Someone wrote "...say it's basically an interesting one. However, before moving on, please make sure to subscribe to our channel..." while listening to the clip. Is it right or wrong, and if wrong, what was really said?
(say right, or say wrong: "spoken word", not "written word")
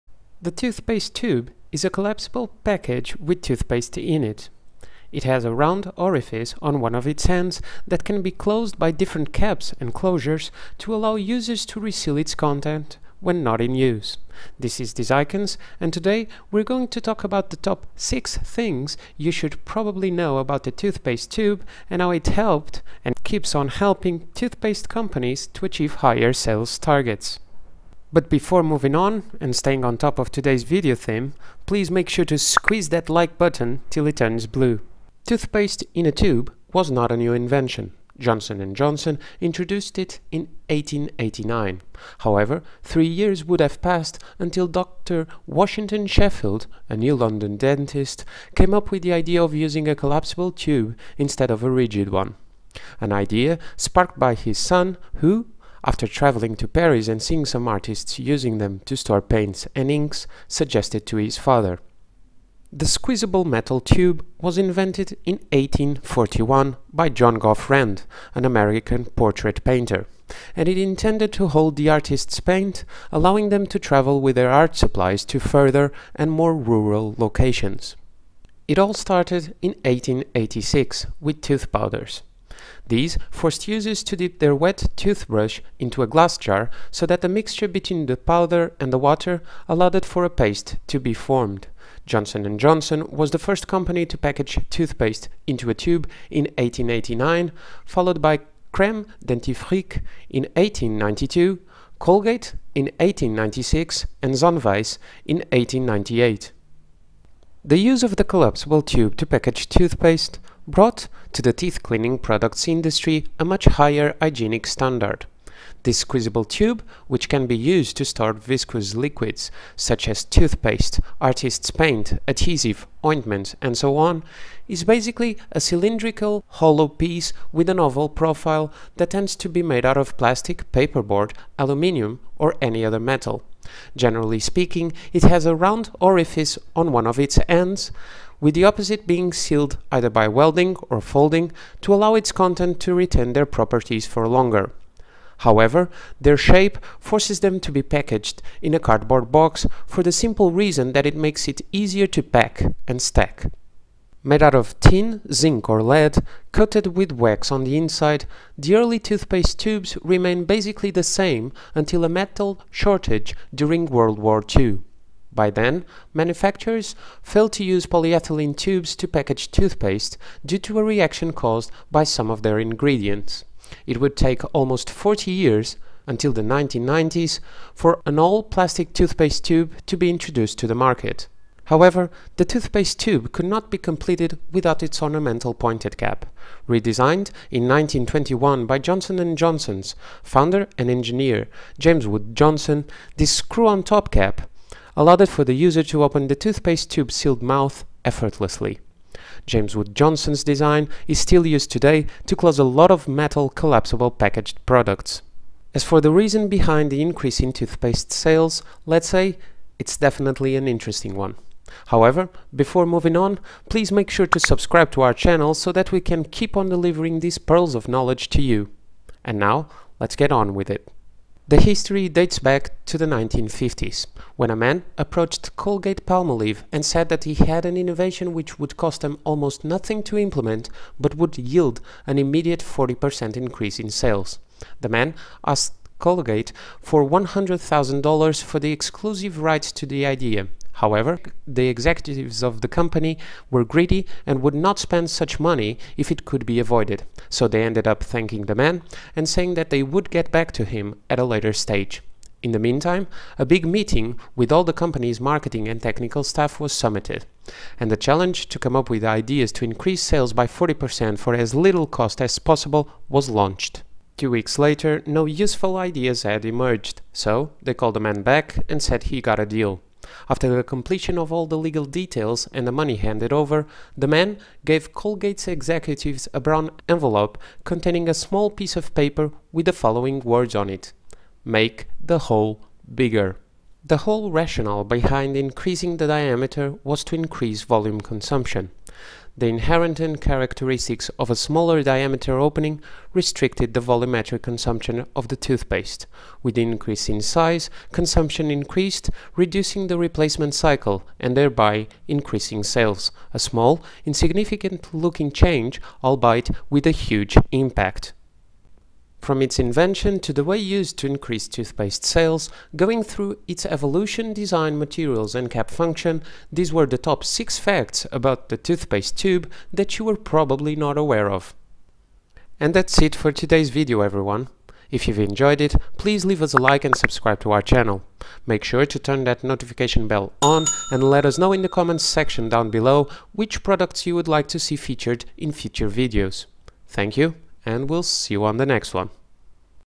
wrong: "definitely", not "basically".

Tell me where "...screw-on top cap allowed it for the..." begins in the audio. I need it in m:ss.
3:13.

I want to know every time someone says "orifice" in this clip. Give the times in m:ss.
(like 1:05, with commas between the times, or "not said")
0:05, 2:15.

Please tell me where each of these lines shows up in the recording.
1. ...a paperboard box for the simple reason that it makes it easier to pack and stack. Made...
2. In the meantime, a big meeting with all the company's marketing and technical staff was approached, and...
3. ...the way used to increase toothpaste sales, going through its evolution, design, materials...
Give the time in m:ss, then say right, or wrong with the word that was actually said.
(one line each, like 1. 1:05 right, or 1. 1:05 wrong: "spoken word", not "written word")
1. 2:28 wrong: "cardboard", not "paperboard"
2. 4:12 wrong: "summited", not "approached"
3. 5:10 right.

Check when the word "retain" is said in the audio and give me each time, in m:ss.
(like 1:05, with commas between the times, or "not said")
2:22.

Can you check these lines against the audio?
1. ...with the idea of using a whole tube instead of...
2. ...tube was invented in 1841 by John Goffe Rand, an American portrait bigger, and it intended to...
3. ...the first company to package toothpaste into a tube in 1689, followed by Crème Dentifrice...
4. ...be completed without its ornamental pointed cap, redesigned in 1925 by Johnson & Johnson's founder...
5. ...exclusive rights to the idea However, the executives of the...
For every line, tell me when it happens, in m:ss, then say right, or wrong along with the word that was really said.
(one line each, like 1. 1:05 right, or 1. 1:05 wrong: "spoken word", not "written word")
1. 0:48 wrong: "collapsible", not "whole"
2. 1:03 wrong: "painter", not "bigger"
3. 1:33 wrong: "1889", not "1689"
4. 3:03 wrong: "1921", not "1925"
5. 3:58 right.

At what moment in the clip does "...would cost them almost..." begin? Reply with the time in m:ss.
3:48.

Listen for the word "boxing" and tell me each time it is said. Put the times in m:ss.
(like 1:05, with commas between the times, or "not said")
not said.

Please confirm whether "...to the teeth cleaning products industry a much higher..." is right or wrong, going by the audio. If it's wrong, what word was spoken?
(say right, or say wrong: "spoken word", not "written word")
right.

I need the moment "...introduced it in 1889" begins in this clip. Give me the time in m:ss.
0:39.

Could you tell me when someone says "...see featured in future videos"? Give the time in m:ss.
5:34.